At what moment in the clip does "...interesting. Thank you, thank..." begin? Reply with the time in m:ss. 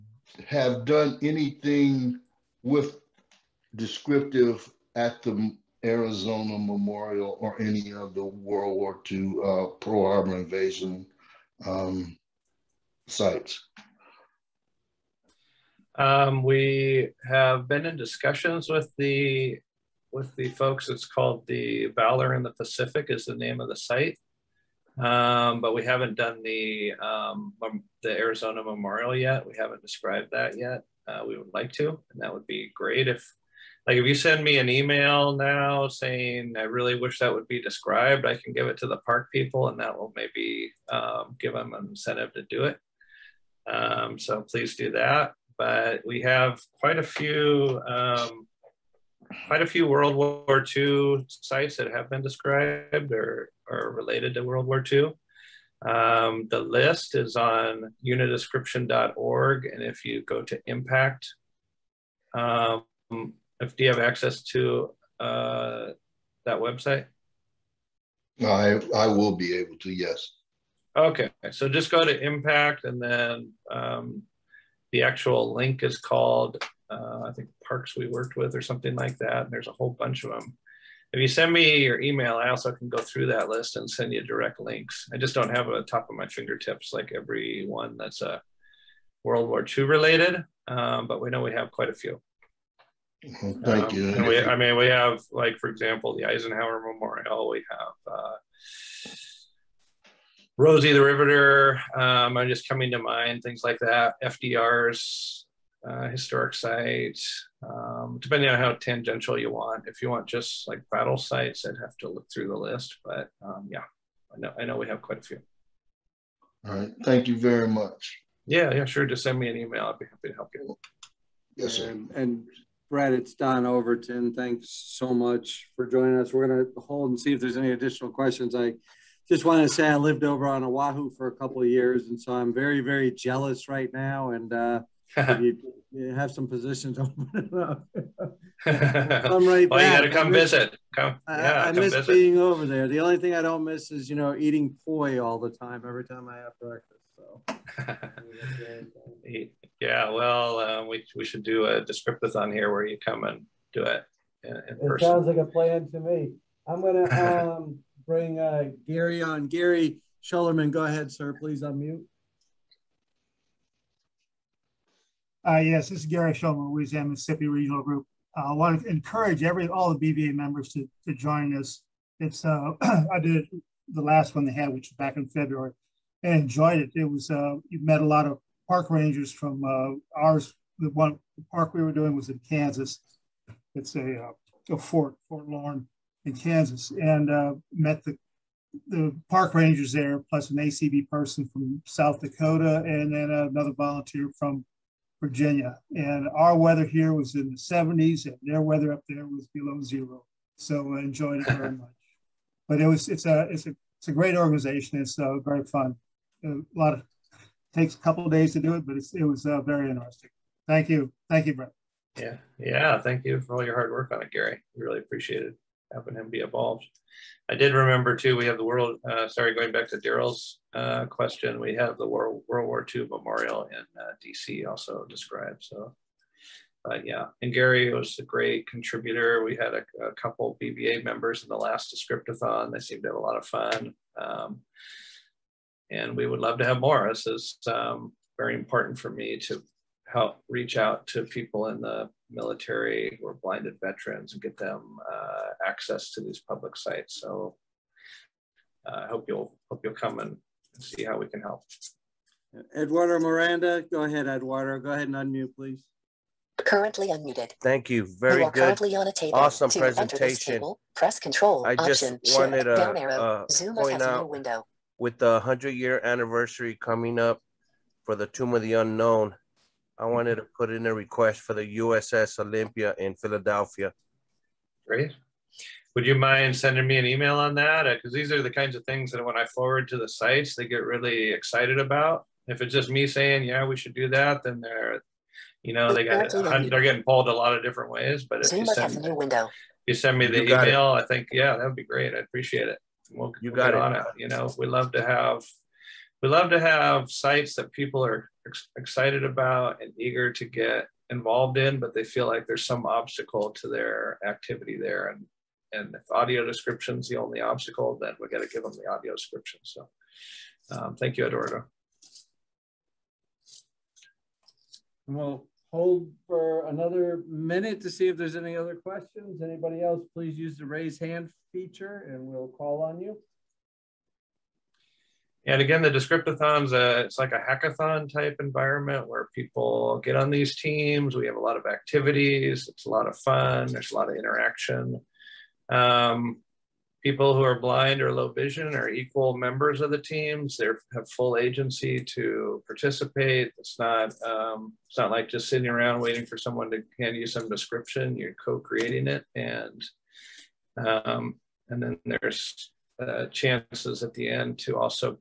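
3:29.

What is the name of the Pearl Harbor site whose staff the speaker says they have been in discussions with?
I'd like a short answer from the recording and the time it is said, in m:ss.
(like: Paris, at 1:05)
Valor in the Pacific, at 0:21.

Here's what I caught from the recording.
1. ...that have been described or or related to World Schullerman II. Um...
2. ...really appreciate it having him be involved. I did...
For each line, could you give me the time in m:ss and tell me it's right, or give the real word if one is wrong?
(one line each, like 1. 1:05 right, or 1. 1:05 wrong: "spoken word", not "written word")
1. 0:51 wrong: "War", not "Schullerman"
2. 3:34 right.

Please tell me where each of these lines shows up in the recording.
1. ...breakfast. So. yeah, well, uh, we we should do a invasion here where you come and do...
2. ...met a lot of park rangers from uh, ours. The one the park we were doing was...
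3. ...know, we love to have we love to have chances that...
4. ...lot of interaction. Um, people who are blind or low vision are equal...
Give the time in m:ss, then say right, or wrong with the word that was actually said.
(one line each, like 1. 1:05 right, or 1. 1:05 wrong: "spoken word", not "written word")
1. 2:26 wrong: "descriptathon", not "invasion"
2. 2:57 right
3. 4:54 wrong: "sites", not "chances"
4. 5:33 right.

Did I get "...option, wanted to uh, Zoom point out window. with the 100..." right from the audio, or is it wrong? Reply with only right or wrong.
right.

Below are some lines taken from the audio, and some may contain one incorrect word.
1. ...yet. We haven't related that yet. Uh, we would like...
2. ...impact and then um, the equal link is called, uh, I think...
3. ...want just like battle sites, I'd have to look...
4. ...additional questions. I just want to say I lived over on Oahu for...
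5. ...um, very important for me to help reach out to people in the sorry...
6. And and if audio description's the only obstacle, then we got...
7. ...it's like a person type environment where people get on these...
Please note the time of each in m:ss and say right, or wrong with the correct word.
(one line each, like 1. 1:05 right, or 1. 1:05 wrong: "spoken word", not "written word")
1. 0:29 wrong: "described", not "related"
2. 1:12 wrong: "actual", not "equal"
3. 1:50 right
4. 2:07 right
5. 3:57 wrong: "military", not "sorry"
6. 5:05 right
7. 5:27 wrong: "hackathon", not "person".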